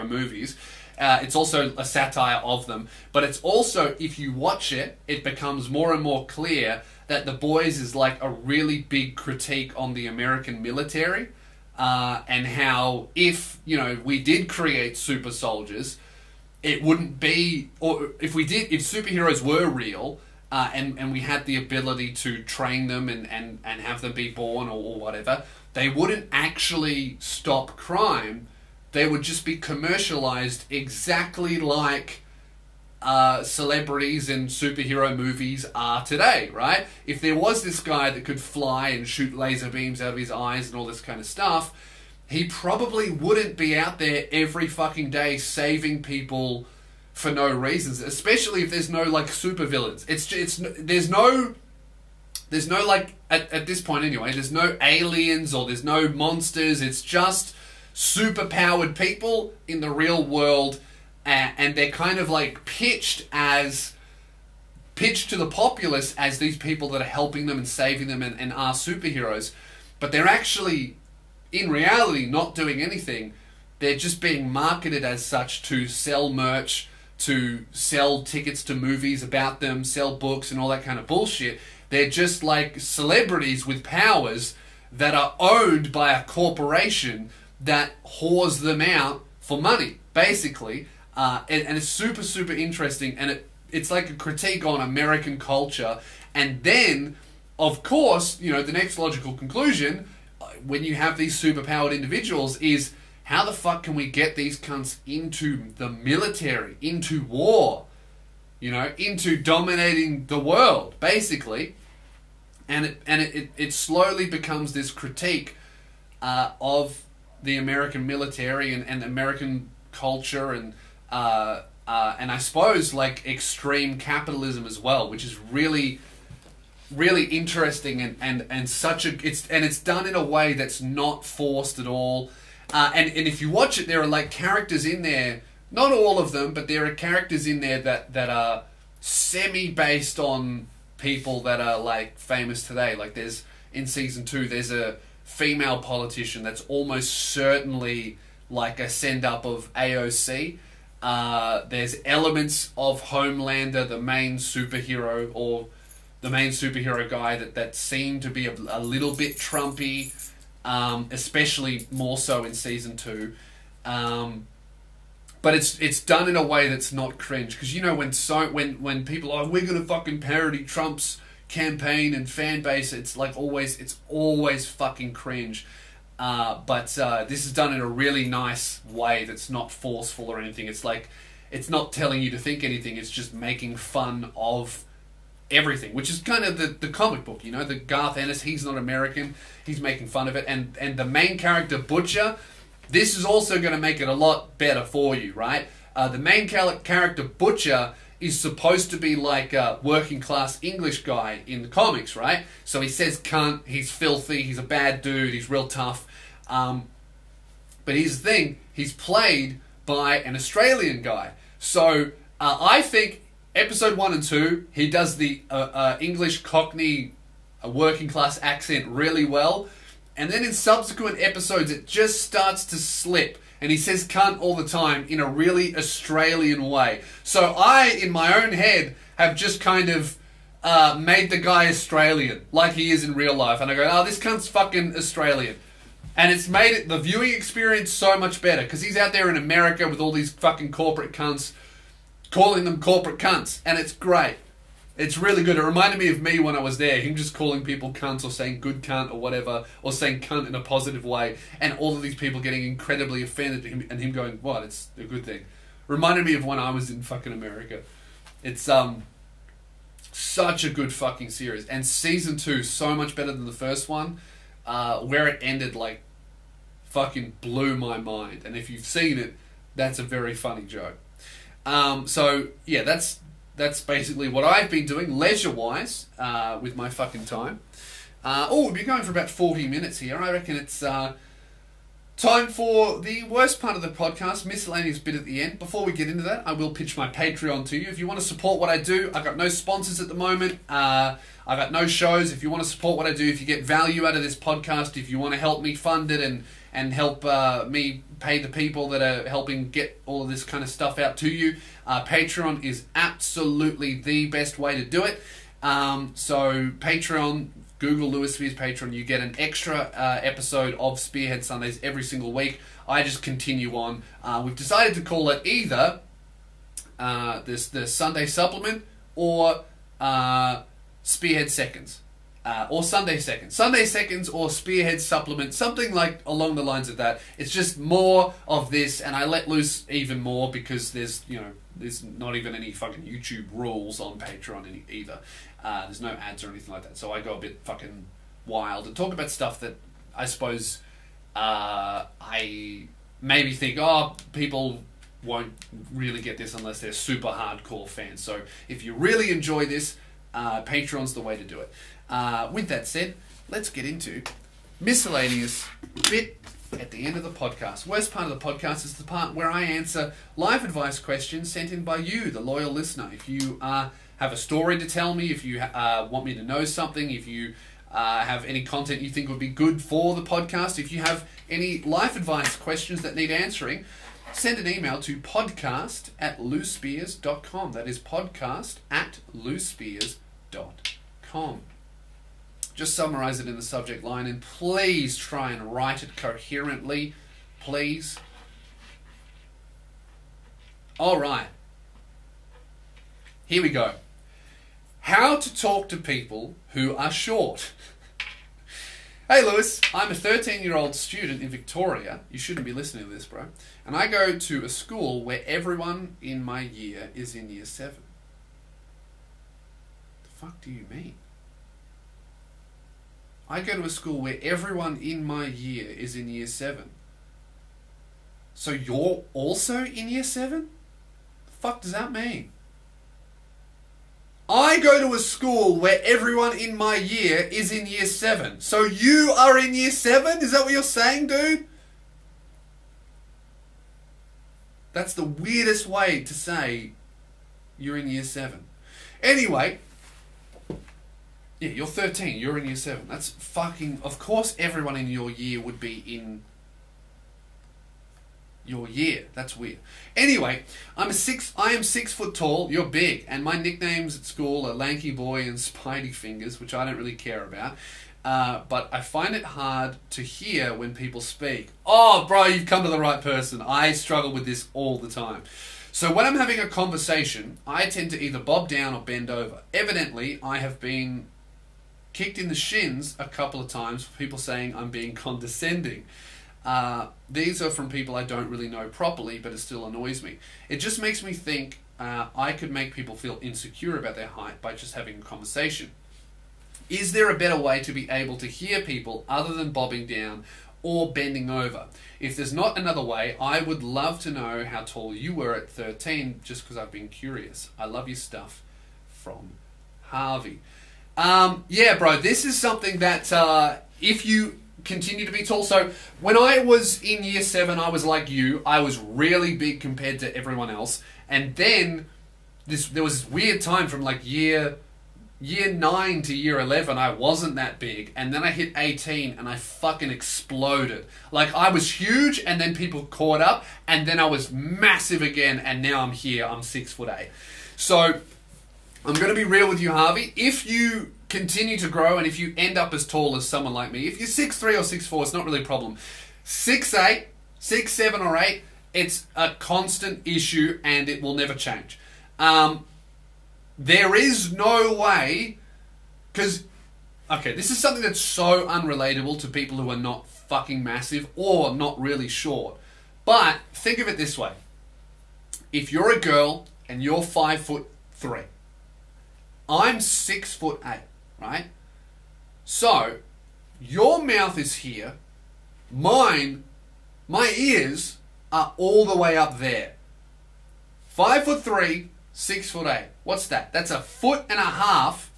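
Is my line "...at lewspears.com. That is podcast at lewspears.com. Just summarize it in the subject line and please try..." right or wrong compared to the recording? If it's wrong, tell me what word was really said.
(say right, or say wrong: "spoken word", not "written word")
right.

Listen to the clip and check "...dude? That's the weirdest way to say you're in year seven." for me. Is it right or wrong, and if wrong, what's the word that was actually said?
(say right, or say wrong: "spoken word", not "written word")
right.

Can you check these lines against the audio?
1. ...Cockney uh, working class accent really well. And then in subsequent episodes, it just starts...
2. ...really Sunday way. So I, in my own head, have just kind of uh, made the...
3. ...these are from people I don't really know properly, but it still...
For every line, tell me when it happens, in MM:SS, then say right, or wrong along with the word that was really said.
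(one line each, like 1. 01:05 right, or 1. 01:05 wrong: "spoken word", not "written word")
1. 03:36 right
2. 03:45 wrong: "Australian", not "Sunday"
3. 07:57 right.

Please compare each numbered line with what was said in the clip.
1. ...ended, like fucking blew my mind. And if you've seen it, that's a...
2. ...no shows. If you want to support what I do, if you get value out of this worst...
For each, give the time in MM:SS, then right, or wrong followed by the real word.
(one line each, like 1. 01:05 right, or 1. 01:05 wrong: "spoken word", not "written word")
1. 04:25 right
2. 04:51 wrong: "podcast", not "worst".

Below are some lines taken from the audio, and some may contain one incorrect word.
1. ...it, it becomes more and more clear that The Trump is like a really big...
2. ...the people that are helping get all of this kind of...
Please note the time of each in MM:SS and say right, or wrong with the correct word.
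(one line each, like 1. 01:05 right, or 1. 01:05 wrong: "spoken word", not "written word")
1. 00:04 wrong: "Boys", not "Trump"
2. 04:58 right.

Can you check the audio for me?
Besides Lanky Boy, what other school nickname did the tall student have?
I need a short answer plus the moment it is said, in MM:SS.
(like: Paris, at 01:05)
Spidey Fingers, at 07:35.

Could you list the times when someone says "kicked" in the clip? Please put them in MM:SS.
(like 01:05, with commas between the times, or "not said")
07:52.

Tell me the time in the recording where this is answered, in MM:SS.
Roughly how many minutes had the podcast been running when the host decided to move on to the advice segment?
04:39.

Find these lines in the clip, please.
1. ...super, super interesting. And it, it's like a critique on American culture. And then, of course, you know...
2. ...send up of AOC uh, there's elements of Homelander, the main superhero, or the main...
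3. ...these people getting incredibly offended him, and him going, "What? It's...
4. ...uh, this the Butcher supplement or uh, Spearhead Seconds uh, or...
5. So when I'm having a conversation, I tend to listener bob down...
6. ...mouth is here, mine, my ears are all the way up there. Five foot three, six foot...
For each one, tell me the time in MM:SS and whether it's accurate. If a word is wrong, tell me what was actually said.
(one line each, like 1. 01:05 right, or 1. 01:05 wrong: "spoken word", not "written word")
1. 01:31 right
2. 02:28 right
3. 04:12 right
4. 05:16 wrong: "Sunday", not "Butcher"
5. 07:45 wrong: "either", not "listener"
6. 09:24 right.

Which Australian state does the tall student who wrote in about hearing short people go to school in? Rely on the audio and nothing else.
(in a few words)
Victoria.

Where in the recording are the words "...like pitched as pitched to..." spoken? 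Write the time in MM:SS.
01:02.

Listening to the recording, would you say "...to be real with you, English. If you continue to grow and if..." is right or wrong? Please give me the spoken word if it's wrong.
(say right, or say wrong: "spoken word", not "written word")
wrong: "Harvey", not "English".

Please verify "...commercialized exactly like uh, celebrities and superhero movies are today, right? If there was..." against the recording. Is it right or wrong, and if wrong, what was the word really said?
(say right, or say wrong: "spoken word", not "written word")
right.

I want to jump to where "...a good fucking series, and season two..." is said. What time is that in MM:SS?
04:20.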